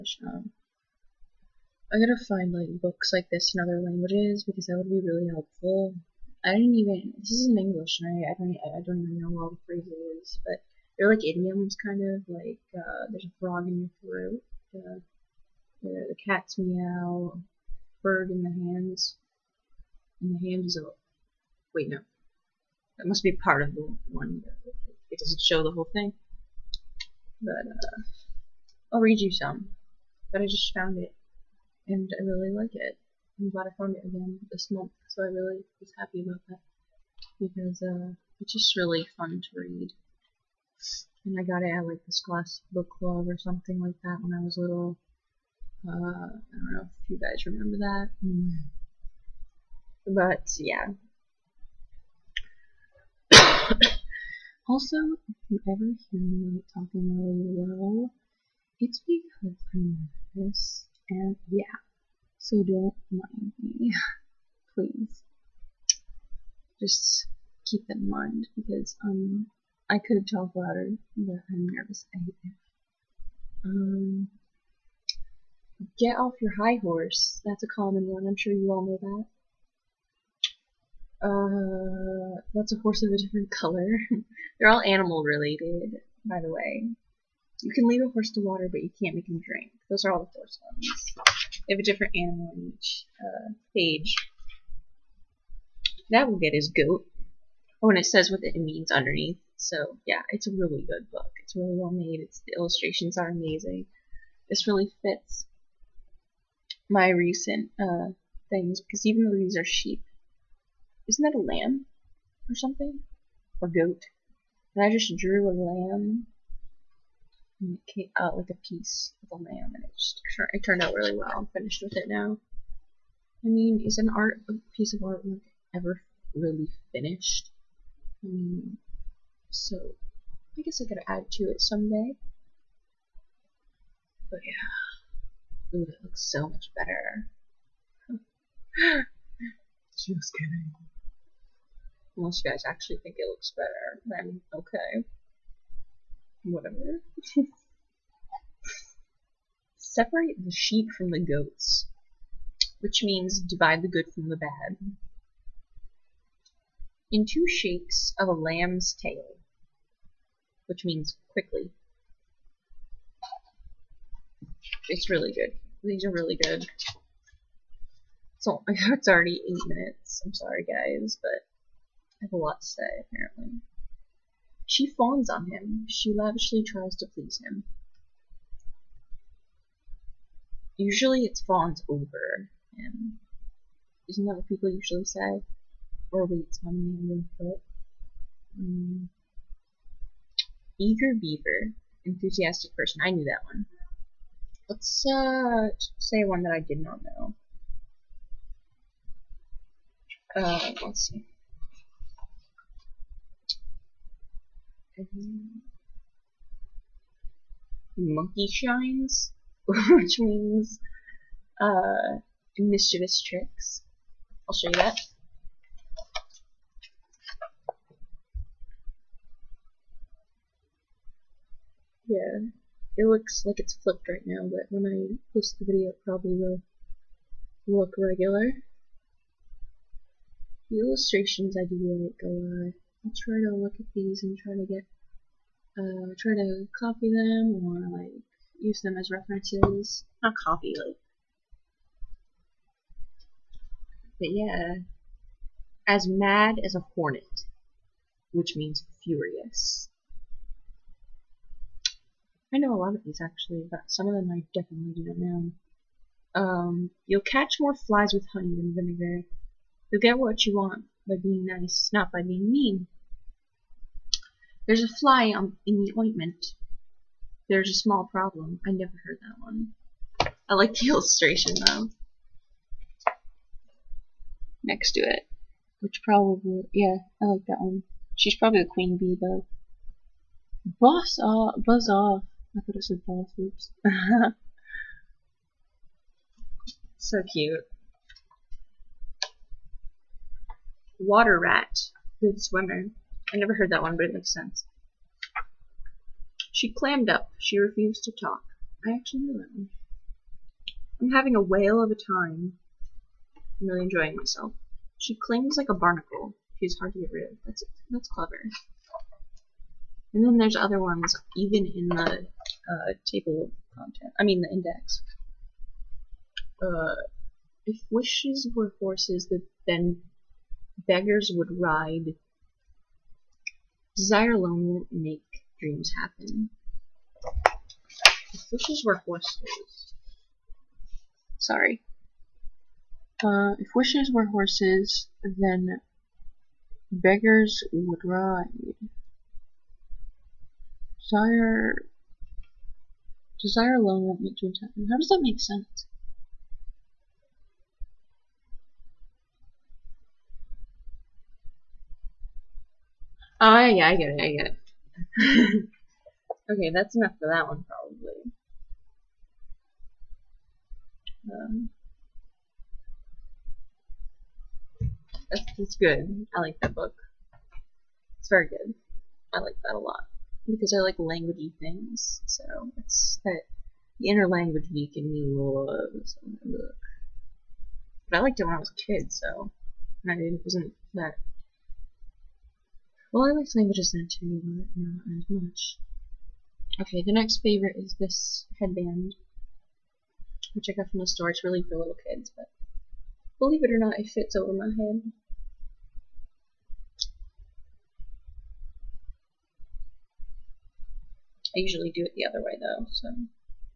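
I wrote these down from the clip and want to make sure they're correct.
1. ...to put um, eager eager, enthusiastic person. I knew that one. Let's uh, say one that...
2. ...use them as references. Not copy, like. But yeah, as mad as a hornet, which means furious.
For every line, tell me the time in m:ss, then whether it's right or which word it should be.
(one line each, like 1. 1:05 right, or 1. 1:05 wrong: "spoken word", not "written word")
1. 3:07 wrong: "beaver", not "eager"
2. 3:58 right.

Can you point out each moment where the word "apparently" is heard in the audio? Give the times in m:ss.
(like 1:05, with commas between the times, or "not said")
2:53.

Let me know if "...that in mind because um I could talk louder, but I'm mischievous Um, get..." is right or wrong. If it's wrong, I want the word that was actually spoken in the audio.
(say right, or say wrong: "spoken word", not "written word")
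wrong: "nervous", not "mischievous".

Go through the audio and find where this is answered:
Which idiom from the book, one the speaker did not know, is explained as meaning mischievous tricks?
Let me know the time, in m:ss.
3:27.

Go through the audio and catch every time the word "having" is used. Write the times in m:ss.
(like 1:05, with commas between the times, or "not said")
5:01.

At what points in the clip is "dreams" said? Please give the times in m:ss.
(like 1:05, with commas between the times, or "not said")
5:25, 5:44.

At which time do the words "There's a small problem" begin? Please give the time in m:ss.
4:27.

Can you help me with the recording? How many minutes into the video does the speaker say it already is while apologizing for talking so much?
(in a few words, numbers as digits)
8.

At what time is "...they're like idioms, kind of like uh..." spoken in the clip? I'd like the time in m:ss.
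0:10.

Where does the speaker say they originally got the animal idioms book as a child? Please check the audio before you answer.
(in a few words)
classic Book Club.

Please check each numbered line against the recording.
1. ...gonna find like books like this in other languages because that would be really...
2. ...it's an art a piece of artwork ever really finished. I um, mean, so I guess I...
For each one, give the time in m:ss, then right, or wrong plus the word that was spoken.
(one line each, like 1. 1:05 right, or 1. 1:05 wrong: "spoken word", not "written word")
1. 0:02 right
2. 2:03 right.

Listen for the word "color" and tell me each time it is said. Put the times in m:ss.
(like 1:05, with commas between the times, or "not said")
1:23.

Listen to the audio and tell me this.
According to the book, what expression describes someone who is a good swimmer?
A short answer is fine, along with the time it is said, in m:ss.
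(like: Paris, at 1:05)
Water rat, at 4:50.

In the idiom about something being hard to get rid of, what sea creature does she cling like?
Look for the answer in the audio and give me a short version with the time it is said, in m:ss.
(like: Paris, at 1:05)
barnacle, at 5:05.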